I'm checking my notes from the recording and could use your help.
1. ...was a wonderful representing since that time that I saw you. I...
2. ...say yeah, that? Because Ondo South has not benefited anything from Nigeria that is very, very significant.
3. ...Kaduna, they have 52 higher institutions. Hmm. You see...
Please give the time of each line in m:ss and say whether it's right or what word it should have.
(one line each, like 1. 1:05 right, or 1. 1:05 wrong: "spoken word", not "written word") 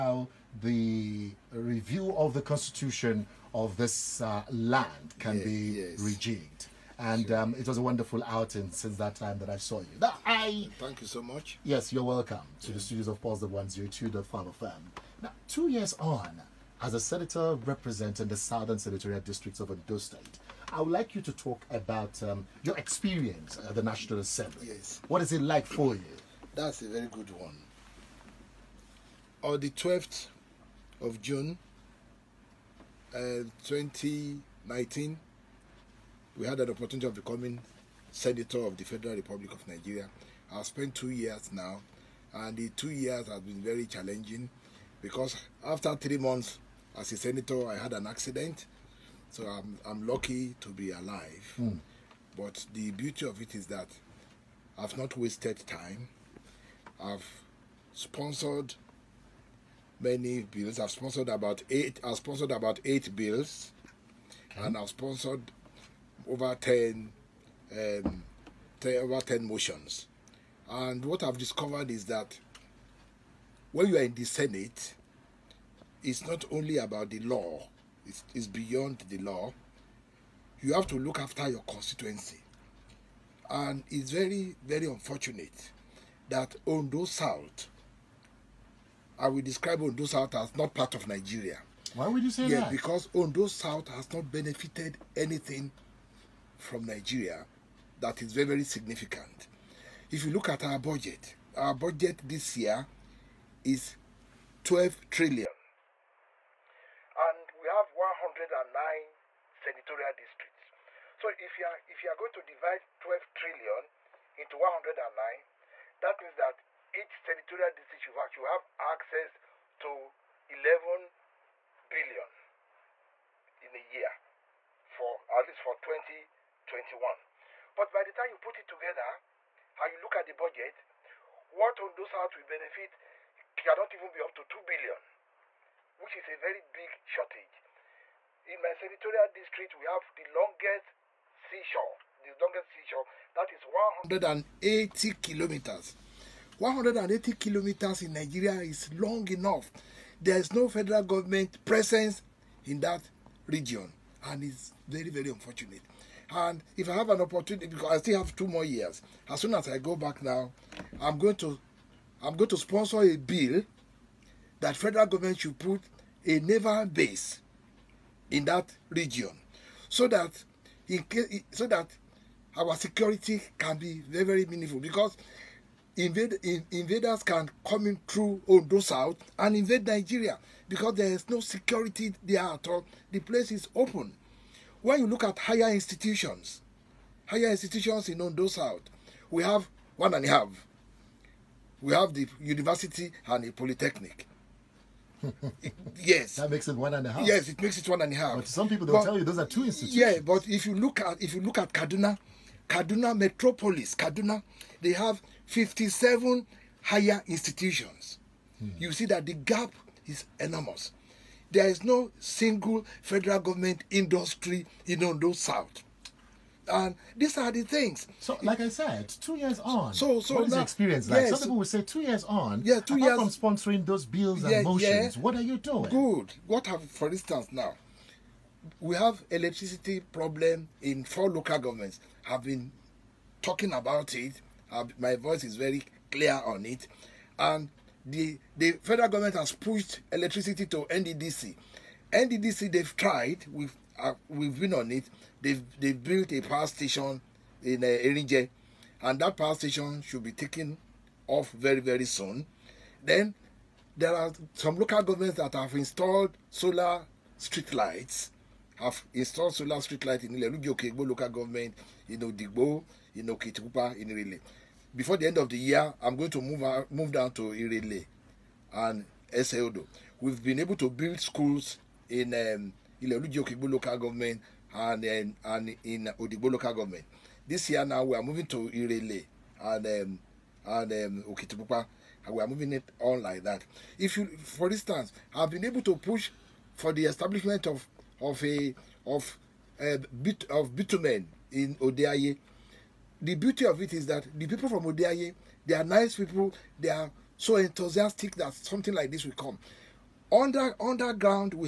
1. 0:07 wrong: "outing", not "representing"
2. 1:32 right
3. 3:23 wrong: "57", not "52".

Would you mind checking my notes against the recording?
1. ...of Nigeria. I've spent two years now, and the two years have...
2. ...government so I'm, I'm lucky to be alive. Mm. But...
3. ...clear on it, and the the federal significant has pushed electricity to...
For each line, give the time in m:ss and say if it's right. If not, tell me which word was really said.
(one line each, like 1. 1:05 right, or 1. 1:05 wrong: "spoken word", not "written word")
1. 0:39 right
2. 0:48 wrong: "accident", not "government"
3. 3:56 wrong: "government", not "significant".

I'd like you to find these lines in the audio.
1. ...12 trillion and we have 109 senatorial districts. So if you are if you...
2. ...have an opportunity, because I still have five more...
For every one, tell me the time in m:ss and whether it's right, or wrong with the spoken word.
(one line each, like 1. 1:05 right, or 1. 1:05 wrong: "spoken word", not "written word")
1. 1:44 right
2. 2:36 wrong: "two", not "five".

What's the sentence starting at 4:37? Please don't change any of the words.
This year now we are moving to Irele and um, and um, Okitipupa.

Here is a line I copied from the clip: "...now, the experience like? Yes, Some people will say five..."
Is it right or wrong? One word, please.
wrong.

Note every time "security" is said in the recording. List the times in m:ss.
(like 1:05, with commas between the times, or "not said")
2:52, 3:01.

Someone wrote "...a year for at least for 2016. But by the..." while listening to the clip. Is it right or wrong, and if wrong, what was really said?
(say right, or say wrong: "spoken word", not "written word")
wrong: "2021", not "2016".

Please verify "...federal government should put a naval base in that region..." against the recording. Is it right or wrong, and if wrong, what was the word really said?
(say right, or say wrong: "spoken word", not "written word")
right.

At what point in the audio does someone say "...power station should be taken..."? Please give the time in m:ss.
4:09.